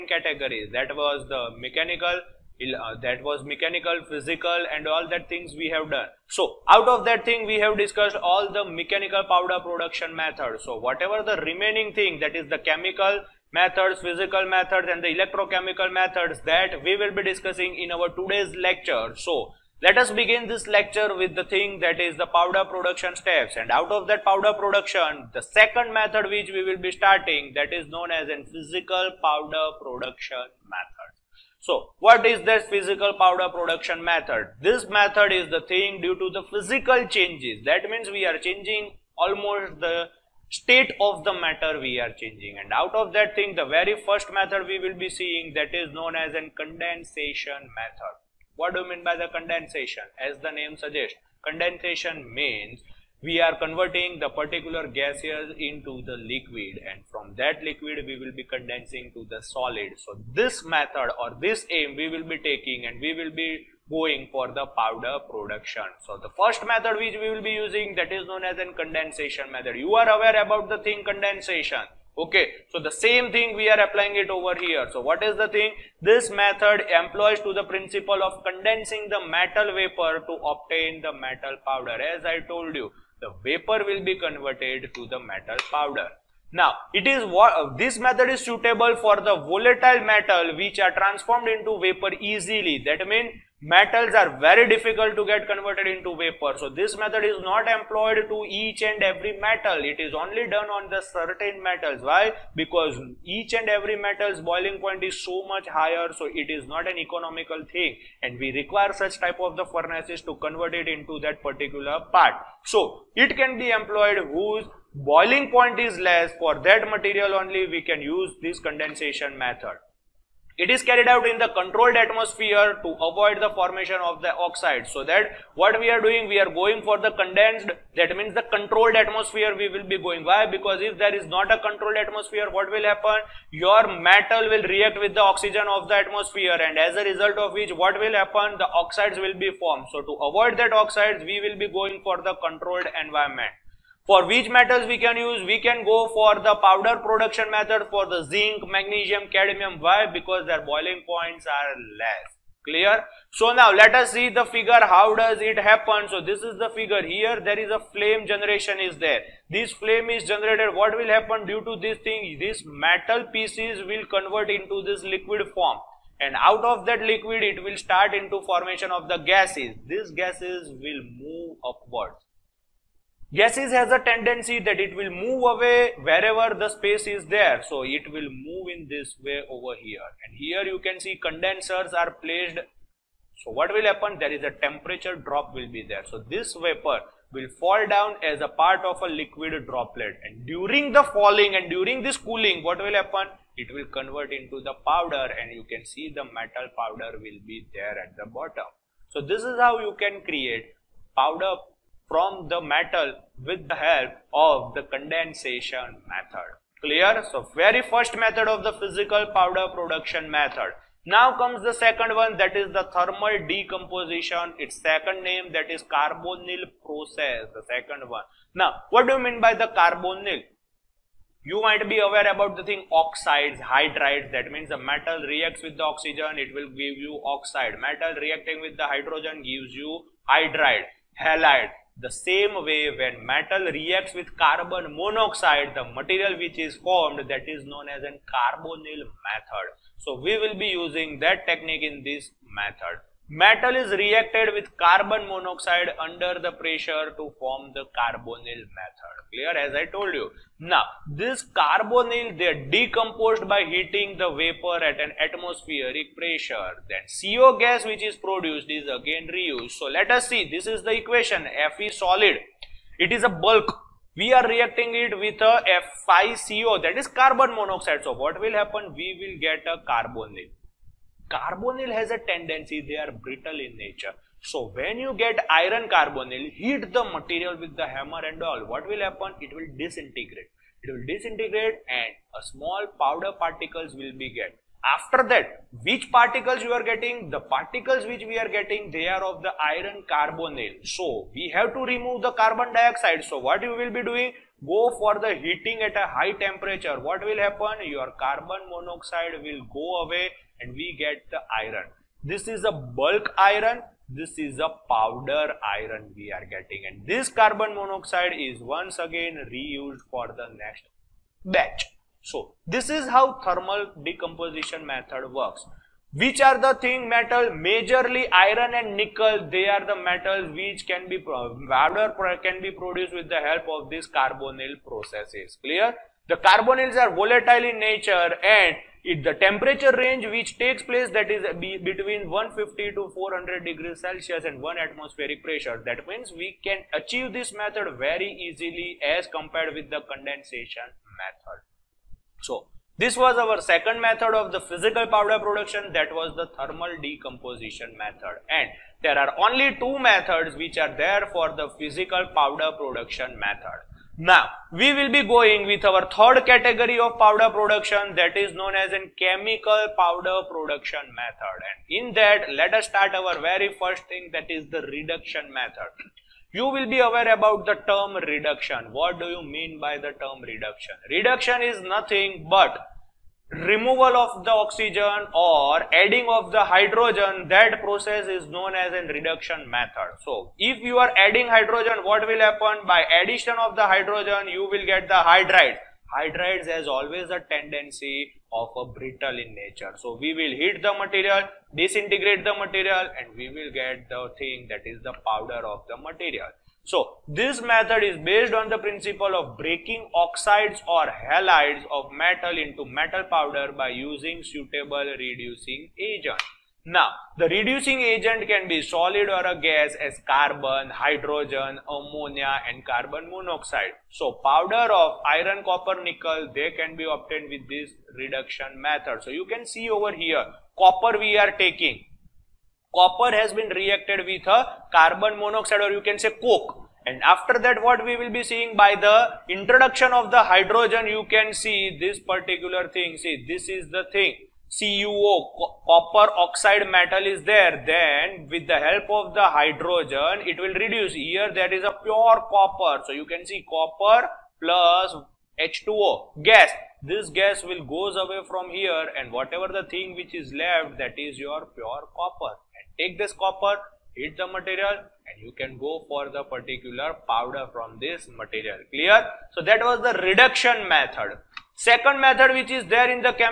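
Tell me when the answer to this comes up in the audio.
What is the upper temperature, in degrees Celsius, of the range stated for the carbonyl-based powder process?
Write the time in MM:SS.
05:33.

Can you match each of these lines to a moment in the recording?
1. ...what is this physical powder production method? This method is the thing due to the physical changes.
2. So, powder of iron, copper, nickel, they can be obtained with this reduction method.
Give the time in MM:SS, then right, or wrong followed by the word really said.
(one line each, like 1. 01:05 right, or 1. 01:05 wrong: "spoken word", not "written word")
1. 00:31 right
2. 06:54 right.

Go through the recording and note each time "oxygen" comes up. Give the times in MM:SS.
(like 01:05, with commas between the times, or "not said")
02:15, 03:45, 06:14.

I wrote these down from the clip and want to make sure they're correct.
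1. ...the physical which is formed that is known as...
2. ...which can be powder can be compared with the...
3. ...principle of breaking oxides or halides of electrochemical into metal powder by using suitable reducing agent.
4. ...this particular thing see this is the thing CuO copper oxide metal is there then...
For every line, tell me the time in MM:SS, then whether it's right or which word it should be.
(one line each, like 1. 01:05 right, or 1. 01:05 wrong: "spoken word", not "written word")
1. 03:55 wrong: "material", not "physical"
2. 05:20 wrong: "produced", not "compared"
3. 06:38 wrong: "metal", not "electrochemical"
4. 07:11 right.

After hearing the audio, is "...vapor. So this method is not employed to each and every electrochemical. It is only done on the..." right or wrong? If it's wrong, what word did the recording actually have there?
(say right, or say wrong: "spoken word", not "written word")
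wrong: "metal", not "electrochemical".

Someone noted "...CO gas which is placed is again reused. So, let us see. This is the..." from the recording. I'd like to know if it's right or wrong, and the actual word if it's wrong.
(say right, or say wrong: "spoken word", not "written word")
wrong: "produced", not "placed".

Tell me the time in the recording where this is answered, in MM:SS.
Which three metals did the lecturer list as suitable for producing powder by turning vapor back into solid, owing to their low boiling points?
02:28.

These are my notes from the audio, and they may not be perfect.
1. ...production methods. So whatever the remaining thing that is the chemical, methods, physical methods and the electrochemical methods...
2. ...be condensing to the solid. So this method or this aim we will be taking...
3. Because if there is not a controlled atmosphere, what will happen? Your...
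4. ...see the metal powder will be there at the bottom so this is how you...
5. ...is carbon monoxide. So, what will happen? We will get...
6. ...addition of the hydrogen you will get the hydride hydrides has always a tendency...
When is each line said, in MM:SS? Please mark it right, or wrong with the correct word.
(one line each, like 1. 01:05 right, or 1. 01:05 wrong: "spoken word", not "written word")
1. 00:09 right
2. 00:58 right
3. 02:10 right
4. 03:15 right
5. 04:26 right
6. 06:23 right.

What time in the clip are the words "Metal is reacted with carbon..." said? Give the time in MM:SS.
04:03.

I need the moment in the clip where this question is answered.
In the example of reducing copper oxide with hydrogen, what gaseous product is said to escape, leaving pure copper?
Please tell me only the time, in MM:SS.
07:25.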